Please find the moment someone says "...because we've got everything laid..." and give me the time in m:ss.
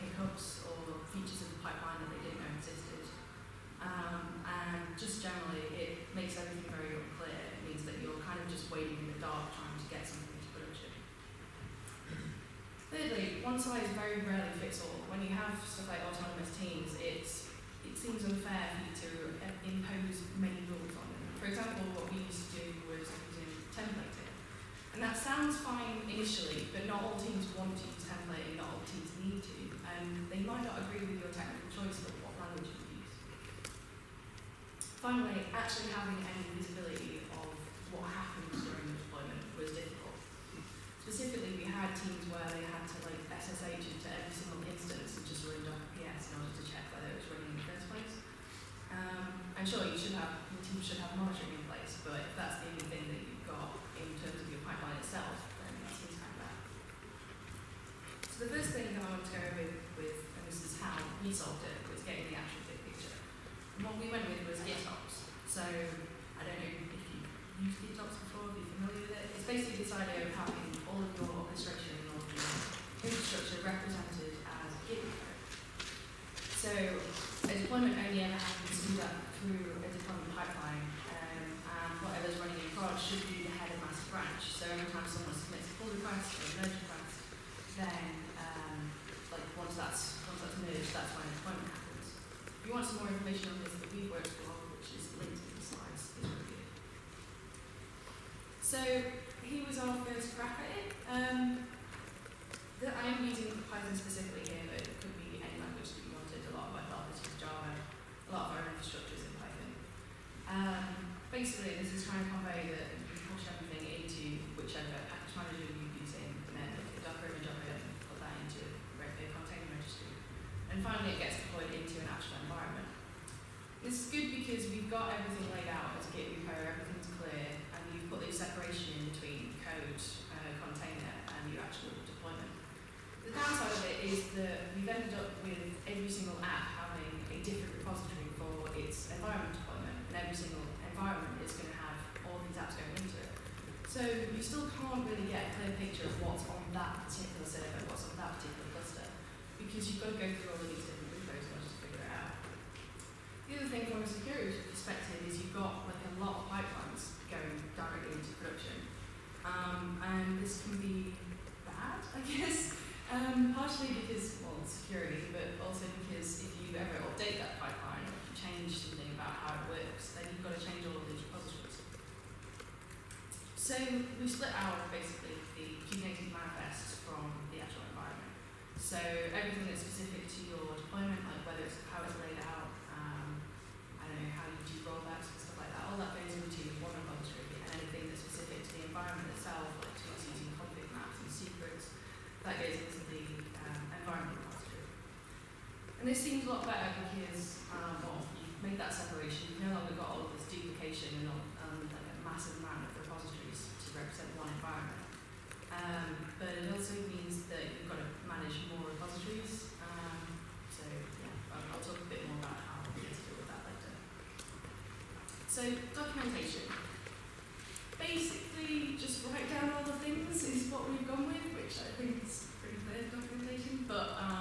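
2:04.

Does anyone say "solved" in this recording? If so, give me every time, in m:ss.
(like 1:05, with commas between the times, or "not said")
1:01.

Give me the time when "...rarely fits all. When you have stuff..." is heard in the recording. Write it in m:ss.
0:14.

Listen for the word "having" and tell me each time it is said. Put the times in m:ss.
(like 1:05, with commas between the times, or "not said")
0:35, 1:10.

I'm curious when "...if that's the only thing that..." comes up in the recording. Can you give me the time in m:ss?
0:52.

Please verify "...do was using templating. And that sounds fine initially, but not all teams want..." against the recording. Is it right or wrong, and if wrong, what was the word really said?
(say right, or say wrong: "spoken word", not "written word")
right.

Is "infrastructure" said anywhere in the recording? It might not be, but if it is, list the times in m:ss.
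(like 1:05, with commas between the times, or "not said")
1:13.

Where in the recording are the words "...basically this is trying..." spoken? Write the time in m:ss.
1:51.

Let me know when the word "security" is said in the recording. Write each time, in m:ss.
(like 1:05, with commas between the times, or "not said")
2:34, 2:44.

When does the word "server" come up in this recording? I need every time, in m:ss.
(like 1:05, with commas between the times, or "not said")
2:27.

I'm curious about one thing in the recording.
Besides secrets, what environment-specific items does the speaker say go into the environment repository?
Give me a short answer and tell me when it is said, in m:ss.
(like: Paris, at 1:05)
Config maps, at 3:10.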